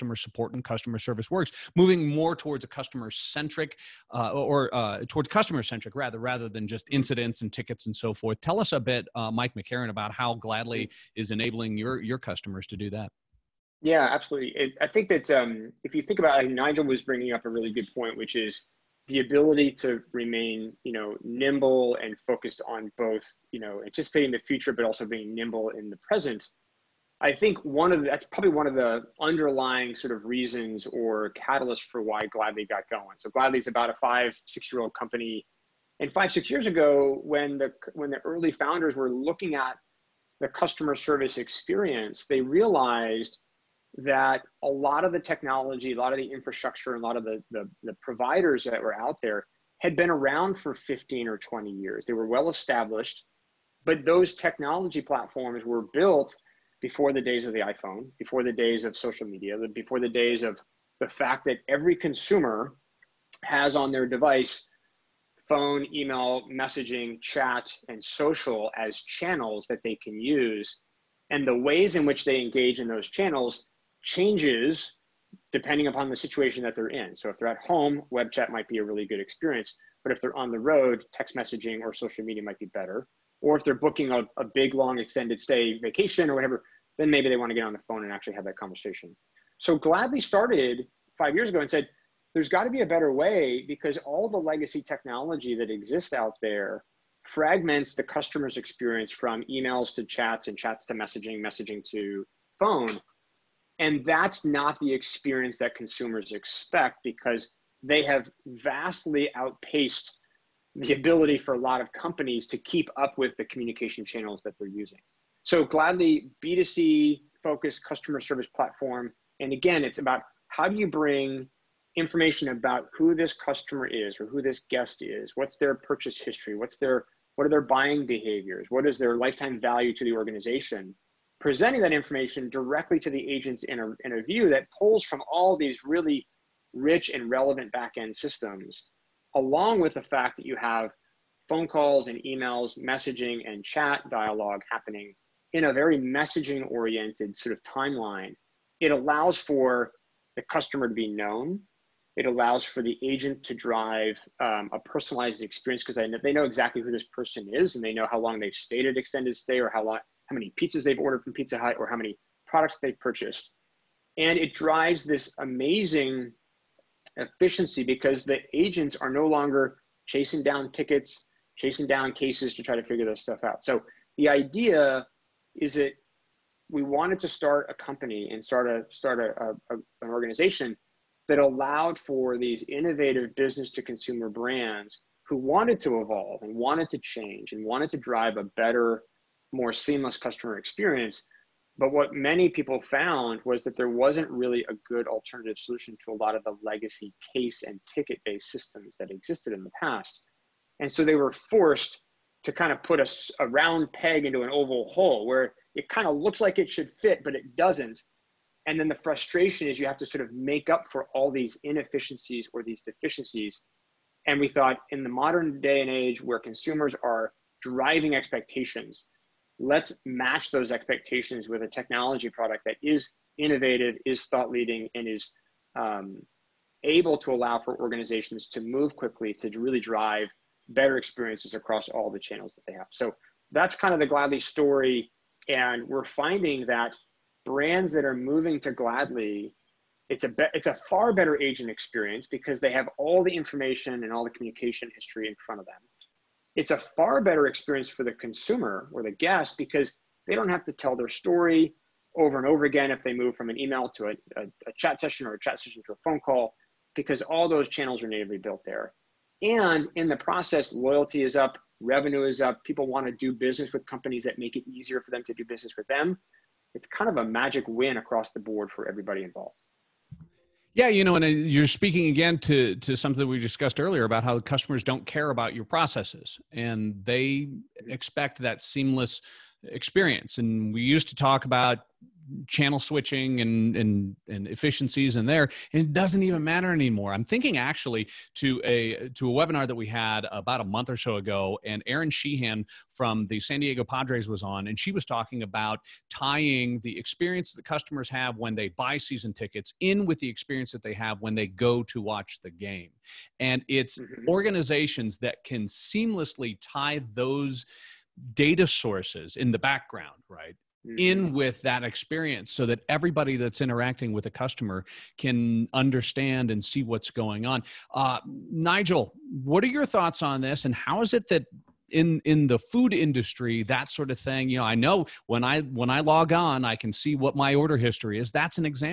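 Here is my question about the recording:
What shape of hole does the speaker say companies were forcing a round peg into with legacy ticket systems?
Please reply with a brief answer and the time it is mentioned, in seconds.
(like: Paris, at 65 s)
Oval, at 204 s.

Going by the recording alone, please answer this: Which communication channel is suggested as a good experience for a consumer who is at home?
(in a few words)
Web chat.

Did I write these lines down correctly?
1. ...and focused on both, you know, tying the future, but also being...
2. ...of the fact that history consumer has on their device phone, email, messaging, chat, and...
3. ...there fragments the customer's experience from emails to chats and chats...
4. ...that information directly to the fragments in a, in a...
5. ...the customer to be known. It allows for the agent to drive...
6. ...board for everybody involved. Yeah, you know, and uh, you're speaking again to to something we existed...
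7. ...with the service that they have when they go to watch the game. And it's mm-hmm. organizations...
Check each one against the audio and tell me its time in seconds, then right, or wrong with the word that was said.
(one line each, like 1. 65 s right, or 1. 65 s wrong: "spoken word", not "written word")
1. 22 s wrong: "anticipating", not "tying"
2. 60 s wrong: "every", not "history"
3. 96 s right
4. 131 s wrong: "agents", not "fragments"
5. 150 s right
6. 268 s wrong: "discussed", not "existed"
7. 300 s wrong: "experience", not "service".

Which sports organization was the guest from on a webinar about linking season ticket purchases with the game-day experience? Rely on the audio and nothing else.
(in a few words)
San Diego Padres.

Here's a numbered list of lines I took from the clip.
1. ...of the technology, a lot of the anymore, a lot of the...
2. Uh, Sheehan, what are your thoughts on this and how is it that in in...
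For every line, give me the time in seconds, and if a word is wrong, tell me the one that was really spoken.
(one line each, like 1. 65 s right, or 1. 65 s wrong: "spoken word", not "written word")
1. 45 s wrong: "infrastructure", not "anymore"
2. 317 s wrong: "Nigel", not "Sheehan".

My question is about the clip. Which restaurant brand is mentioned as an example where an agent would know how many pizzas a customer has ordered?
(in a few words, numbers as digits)
Pizza Hut.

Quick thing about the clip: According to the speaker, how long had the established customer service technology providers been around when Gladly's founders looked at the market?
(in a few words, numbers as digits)
15 or 20 years.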